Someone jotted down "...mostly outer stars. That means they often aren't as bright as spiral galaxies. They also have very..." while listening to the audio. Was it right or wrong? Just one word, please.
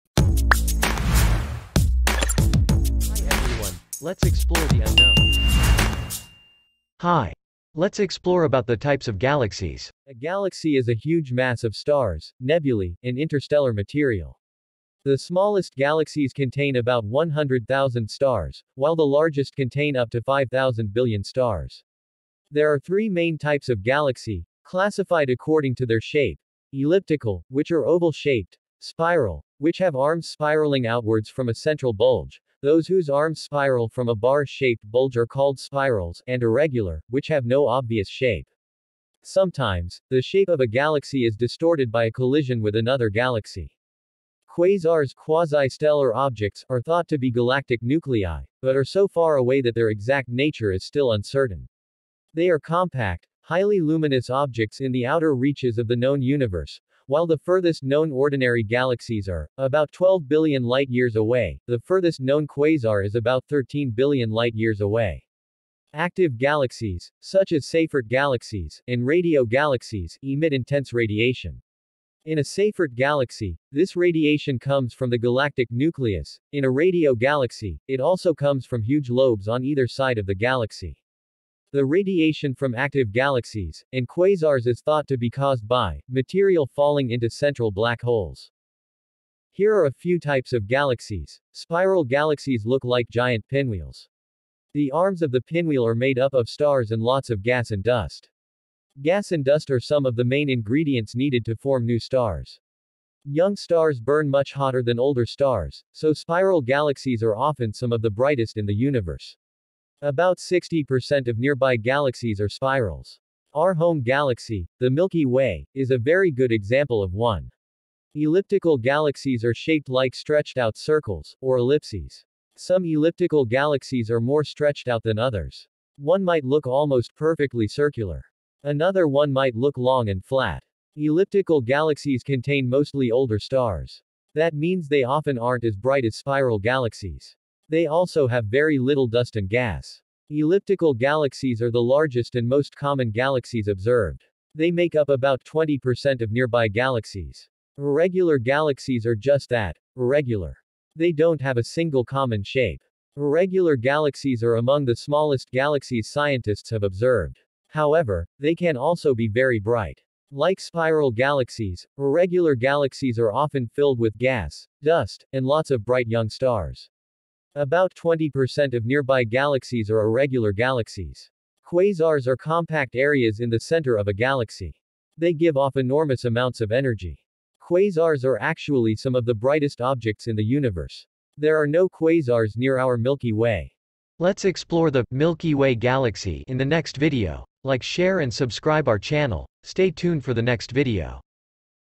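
wrong.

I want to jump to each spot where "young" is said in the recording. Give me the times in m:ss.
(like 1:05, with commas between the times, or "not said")
1:43, 2:46.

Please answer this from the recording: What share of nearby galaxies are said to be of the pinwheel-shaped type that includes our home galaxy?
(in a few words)
60%.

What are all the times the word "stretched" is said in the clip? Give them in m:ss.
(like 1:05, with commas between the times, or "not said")
2:00, 2:04.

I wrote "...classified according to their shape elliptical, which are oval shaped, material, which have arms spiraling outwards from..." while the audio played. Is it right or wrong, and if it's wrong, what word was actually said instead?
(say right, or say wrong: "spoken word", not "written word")
wrong: "spiral", not "material".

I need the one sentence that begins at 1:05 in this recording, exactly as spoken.
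Active galaxies, such as Seyfert galaxies, and radio galaxies, emit intense radiation.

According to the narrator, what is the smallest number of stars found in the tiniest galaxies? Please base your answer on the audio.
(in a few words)
100,000.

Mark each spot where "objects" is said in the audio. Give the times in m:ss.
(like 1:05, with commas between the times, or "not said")
0:46, 0:54, 2:59.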